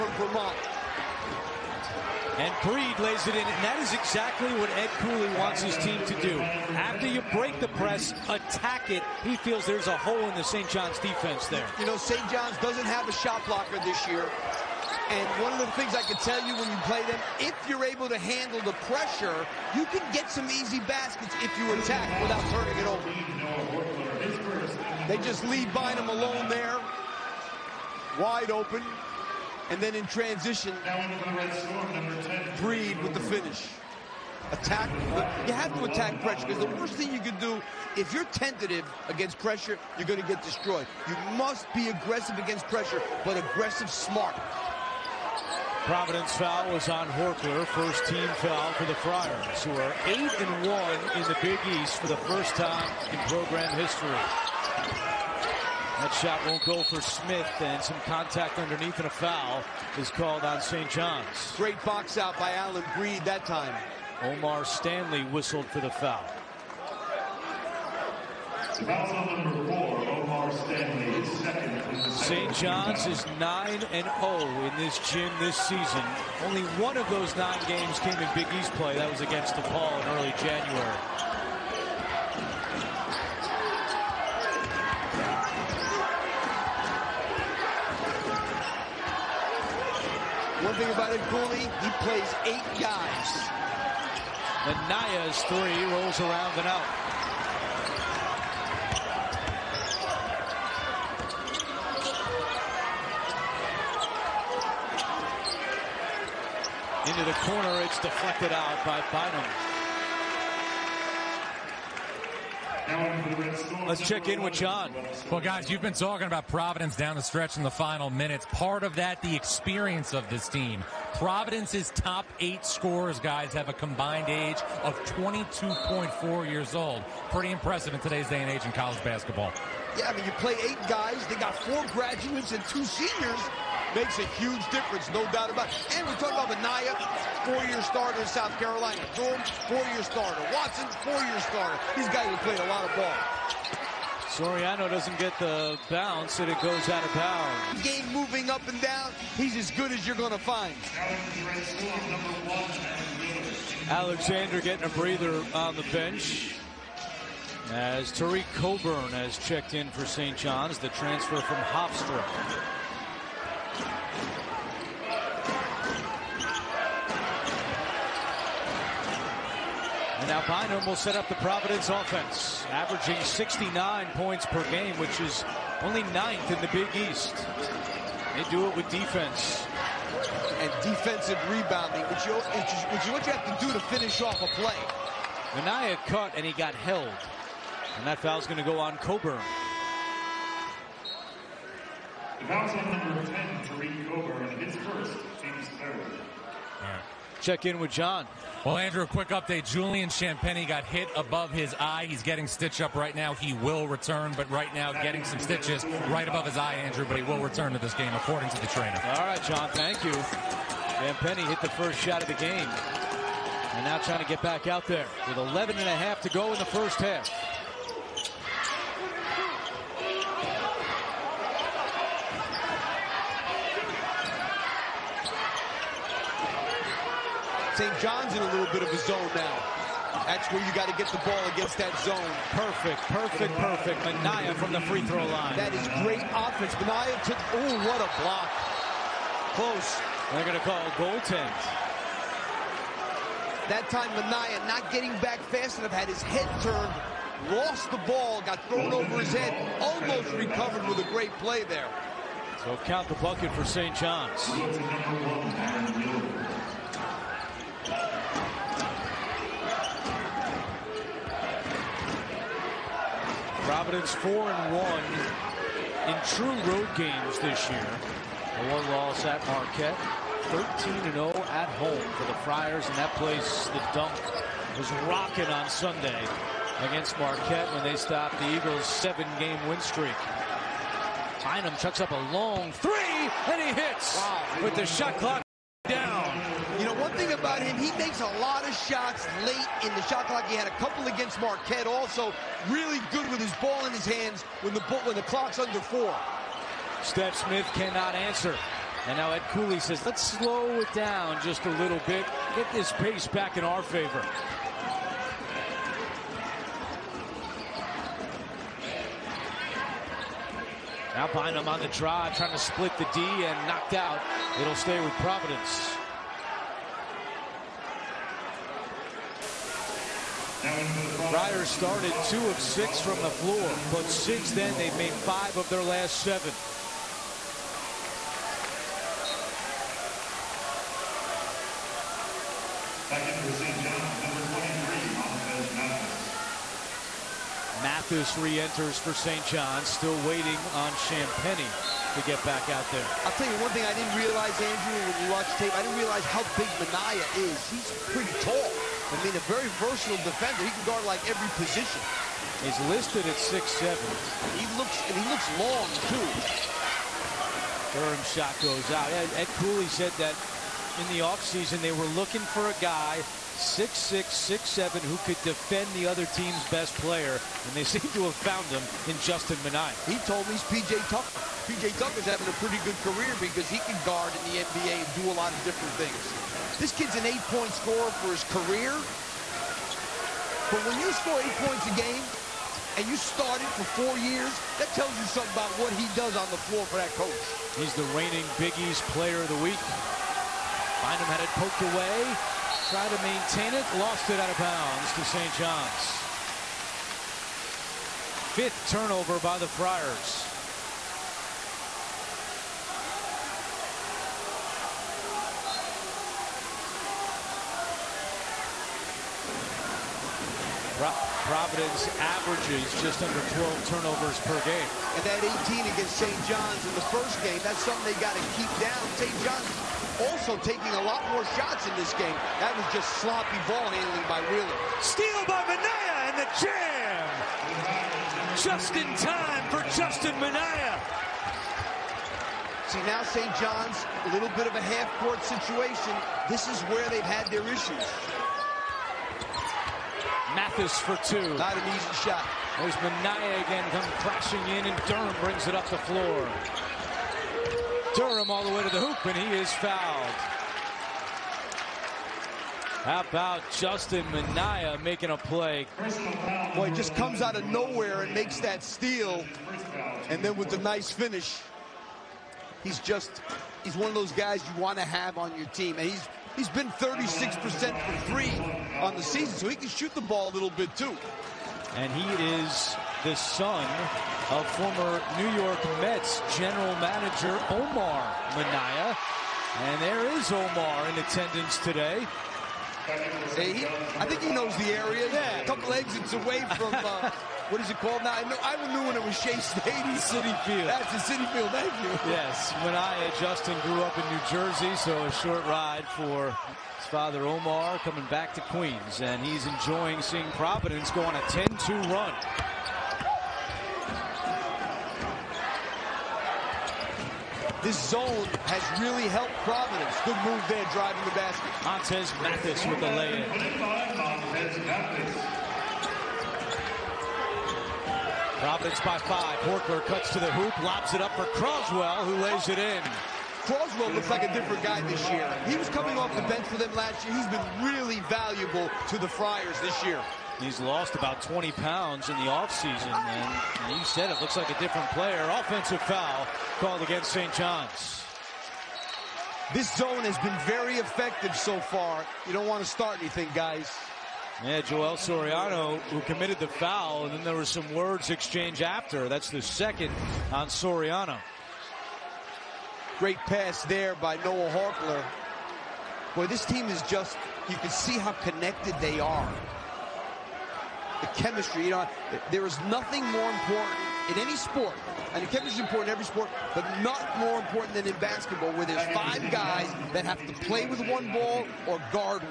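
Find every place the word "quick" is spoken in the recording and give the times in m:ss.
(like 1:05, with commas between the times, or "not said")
3:19.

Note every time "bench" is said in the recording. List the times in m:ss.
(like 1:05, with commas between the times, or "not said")
2:35, 8:46.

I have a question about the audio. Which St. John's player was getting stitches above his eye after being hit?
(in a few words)
Julian Champagnie.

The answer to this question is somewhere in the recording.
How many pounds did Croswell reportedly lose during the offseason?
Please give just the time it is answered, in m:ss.
8:51.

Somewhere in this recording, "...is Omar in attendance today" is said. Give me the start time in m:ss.
8:00.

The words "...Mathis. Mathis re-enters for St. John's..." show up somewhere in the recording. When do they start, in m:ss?
5:35.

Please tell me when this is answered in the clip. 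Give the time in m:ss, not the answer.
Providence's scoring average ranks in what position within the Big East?
2:56.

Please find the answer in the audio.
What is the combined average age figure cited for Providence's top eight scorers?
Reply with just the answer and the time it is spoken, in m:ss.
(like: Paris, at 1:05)
22.4, at 2:05.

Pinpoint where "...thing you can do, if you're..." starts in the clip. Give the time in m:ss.
0:36.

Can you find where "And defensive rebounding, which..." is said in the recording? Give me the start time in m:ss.
3:00.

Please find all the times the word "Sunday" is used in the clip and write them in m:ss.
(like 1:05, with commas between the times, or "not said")
4:35.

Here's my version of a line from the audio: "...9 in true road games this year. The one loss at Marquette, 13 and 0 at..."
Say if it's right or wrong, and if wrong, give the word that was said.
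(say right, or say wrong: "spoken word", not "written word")
wrong: "1", not "9".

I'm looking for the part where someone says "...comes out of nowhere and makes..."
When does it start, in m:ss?
7:37.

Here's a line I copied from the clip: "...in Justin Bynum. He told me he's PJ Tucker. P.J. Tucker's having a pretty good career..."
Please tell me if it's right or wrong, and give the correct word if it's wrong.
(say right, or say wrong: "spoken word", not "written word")
wrong: "Minaya", not "Bynum".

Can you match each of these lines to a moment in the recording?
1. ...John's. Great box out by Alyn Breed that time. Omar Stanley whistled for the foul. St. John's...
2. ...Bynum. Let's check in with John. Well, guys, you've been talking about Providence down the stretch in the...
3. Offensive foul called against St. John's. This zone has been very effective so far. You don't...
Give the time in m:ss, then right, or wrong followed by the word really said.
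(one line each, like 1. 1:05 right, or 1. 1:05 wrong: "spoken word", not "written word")
1. 1:00 right
2. 1:49 right
3. 8:55 right.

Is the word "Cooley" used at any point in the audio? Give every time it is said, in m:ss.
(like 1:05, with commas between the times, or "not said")
0:04, 1:31, 4:59, 5:59.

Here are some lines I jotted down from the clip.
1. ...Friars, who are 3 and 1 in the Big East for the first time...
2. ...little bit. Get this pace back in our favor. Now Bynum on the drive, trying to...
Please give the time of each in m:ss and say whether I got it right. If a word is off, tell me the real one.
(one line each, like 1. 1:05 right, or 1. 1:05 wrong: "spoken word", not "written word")
1. 0:48 wrong: "8", not "3"
2. 5:01 right.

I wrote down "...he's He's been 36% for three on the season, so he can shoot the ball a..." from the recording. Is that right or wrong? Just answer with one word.
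right.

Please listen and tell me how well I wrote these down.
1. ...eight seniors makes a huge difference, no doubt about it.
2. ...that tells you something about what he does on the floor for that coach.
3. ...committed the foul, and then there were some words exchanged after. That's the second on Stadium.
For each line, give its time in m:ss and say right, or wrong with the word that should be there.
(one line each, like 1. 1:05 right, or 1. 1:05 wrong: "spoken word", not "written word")
1. 2:12 wrong: "two", not "eight"
2. 6:24 right
3. 9:06 wrong: "Soriano", not "Stadium".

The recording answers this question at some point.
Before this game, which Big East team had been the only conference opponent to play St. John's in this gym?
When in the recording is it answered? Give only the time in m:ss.
1:19.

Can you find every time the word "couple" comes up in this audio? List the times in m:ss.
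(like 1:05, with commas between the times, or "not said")
4:50, 8:05.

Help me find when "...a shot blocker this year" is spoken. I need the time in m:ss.
0:13.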